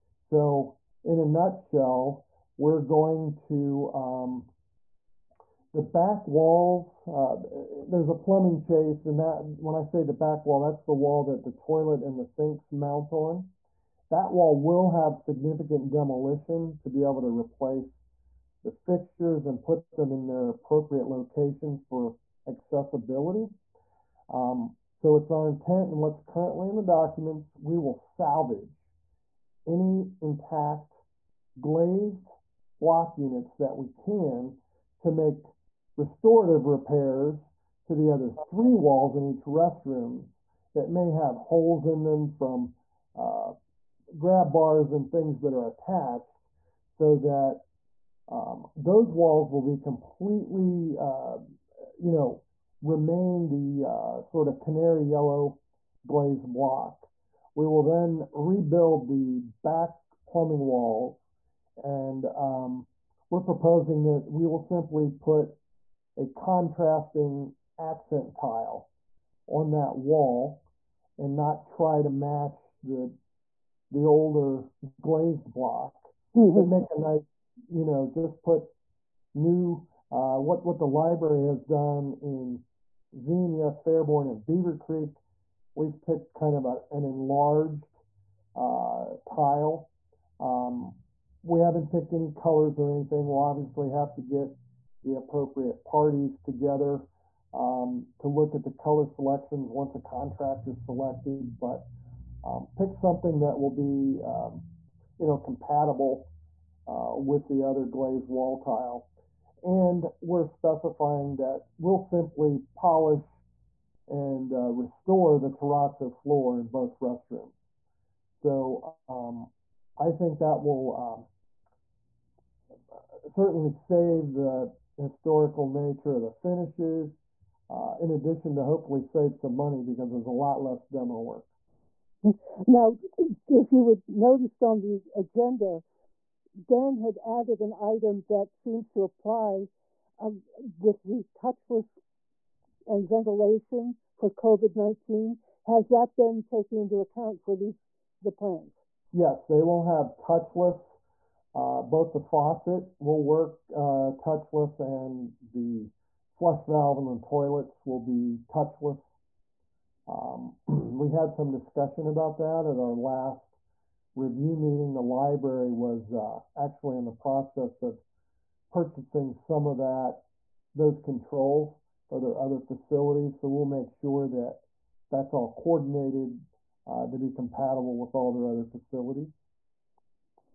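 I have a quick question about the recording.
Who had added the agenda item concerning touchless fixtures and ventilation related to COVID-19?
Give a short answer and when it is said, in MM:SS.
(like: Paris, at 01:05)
Dan, at 02:16.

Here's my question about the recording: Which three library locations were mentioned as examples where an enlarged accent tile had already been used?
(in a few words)
Xenia, Fairborn, and Beavercreek.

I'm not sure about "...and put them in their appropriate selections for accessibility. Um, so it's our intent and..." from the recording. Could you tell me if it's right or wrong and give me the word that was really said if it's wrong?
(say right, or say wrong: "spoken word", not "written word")
wrong: "locations", not "selections".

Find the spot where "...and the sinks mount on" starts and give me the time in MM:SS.
00:12.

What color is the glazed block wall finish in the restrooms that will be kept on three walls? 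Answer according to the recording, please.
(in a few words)
canary yellow.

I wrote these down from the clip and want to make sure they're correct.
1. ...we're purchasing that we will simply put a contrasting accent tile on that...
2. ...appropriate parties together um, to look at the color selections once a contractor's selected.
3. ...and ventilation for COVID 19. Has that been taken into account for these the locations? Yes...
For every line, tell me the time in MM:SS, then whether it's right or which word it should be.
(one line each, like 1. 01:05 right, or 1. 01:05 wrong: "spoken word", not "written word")
1. 01:03 wrong: "proposing", not "purchasing"
2. 01:35 right
3. 02:22 wrong: "plans", not "locations".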